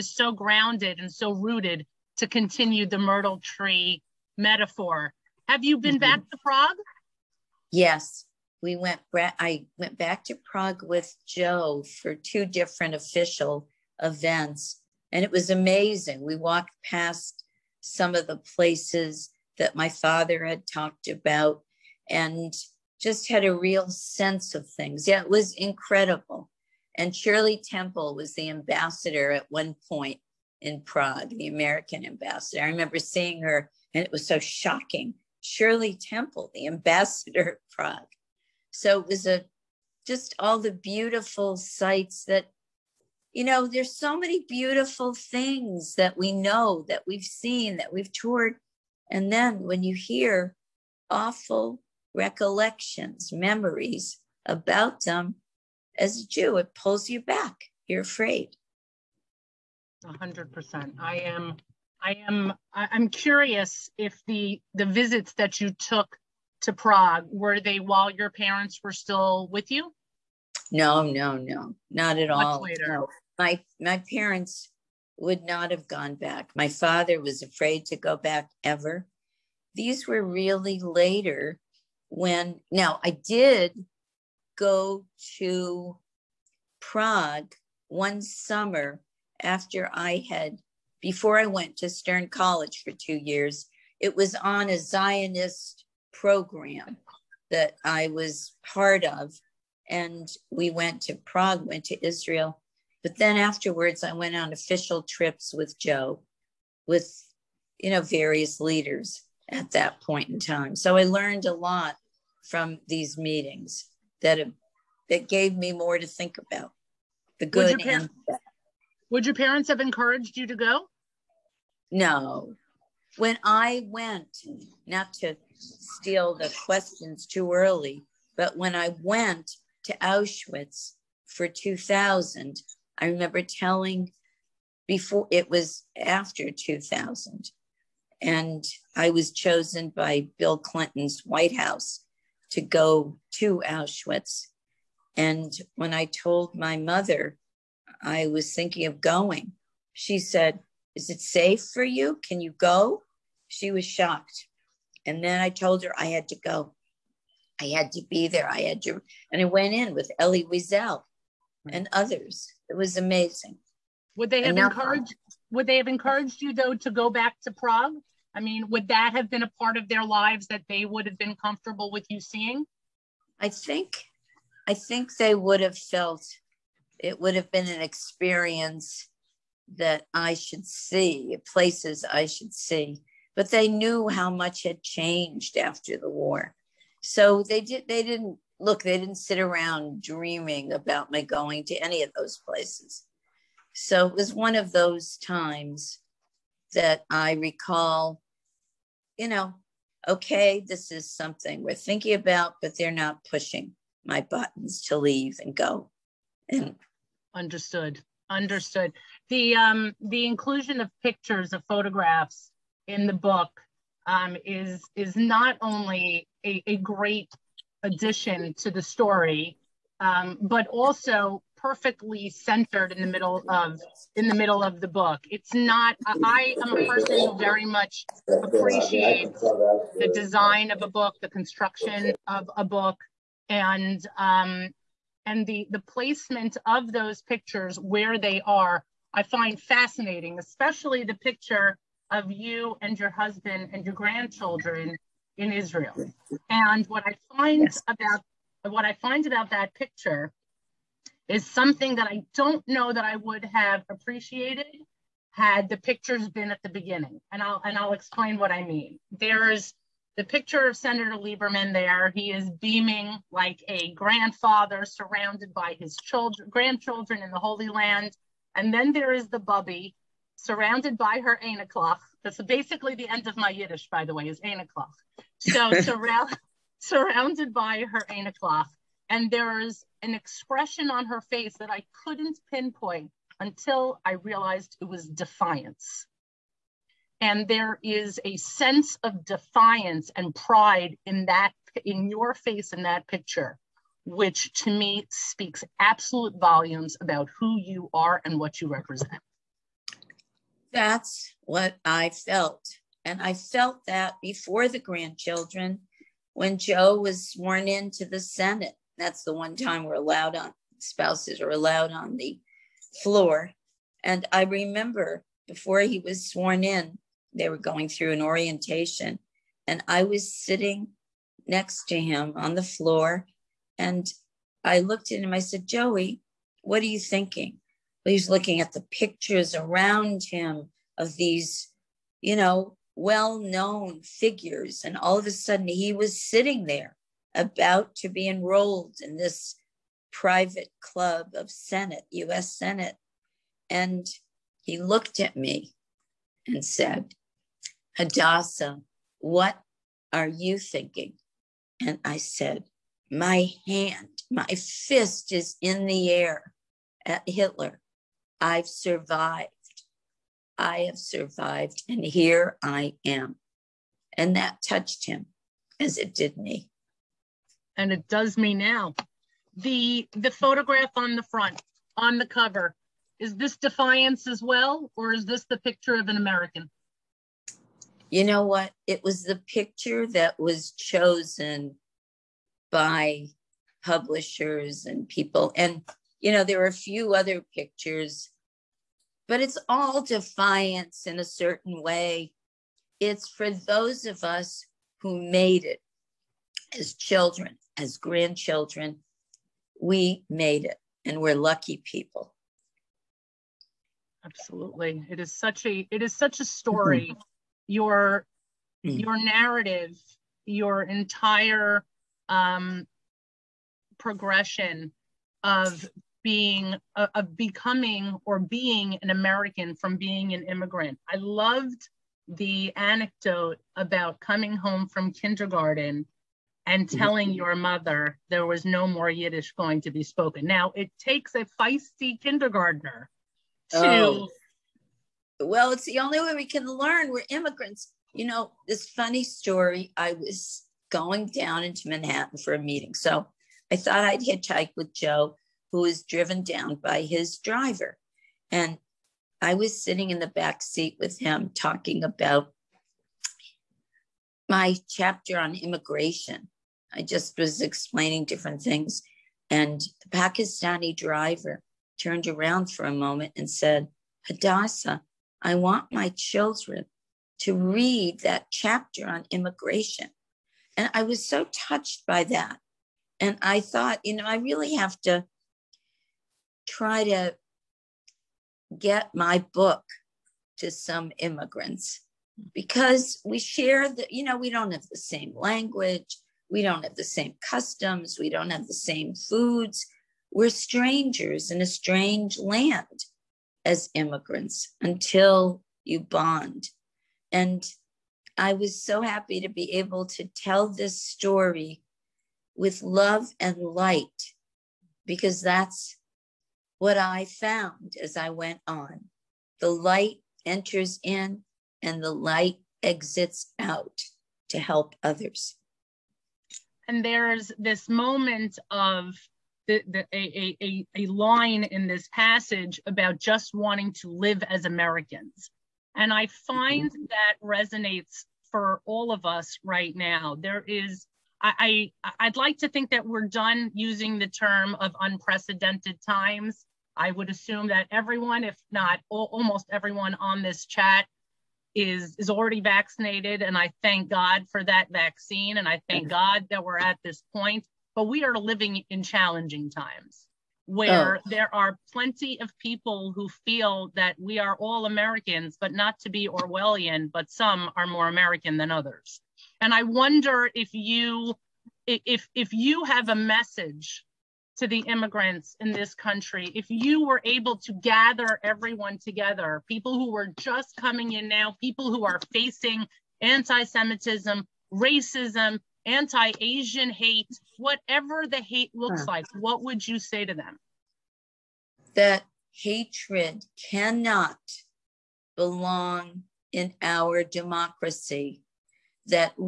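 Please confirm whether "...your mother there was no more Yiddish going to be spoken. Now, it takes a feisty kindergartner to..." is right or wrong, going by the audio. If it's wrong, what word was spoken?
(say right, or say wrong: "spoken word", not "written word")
right.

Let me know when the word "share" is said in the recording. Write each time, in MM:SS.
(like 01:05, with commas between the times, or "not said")
08:03.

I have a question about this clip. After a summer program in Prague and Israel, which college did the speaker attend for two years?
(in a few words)
Stern College.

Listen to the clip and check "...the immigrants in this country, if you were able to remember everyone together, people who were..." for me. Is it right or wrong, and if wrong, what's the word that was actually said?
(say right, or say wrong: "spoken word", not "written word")
wrong: "gather", not "remember".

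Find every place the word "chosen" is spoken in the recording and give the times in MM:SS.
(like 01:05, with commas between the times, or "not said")
02:19, 06:20.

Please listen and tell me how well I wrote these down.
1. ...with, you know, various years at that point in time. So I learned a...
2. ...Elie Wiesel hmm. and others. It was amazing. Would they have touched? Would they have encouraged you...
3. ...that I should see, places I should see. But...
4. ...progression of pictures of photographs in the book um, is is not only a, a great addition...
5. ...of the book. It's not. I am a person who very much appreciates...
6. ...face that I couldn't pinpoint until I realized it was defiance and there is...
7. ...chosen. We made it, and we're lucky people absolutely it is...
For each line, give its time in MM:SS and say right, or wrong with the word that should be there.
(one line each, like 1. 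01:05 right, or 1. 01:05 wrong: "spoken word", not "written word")
1. 01:46 wrong: "leaders", not "years"
2. 02:40 wrong: "encouraged", not "touched"
3. 02:59 right
4. 03:30 wrong: "inclusion", not "progression"
5. 03:44 right
6. 04:41 right
7. 06:37 wrong: "grandchildren", not "chosen".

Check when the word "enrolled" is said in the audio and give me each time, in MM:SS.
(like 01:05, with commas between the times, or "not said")
05:38.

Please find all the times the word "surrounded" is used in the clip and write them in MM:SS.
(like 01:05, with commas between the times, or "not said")
04:24, 04:30, 04:36.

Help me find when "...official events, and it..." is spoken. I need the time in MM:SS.
00:12.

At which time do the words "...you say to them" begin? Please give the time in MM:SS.
09:39.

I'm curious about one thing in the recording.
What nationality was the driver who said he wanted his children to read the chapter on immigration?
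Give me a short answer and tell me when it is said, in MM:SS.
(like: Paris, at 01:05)
Pakistani, at 07:40.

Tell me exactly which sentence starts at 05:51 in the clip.
And I said, My hand, my fist is in the air at Hitler.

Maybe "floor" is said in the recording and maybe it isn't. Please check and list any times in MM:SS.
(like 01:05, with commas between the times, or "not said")
05:13, 05:22.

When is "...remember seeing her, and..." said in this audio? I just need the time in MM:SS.
00:32.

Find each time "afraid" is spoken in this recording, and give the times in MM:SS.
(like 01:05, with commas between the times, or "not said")
00:58, 01:17.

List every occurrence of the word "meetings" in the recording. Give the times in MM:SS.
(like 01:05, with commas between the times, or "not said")
01:53, 07:22.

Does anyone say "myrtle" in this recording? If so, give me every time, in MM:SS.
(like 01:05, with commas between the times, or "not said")
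00:02.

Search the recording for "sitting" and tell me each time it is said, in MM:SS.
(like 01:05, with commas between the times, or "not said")
05:20, 05:36, 07:29.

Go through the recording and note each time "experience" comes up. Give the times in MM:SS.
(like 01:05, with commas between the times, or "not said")
02:57.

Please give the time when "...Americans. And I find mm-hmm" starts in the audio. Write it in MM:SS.
08:44.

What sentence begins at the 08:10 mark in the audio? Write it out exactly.
We're strangers in a strange land as immigrants until you bond.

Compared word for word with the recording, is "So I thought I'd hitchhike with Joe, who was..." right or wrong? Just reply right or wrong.
right.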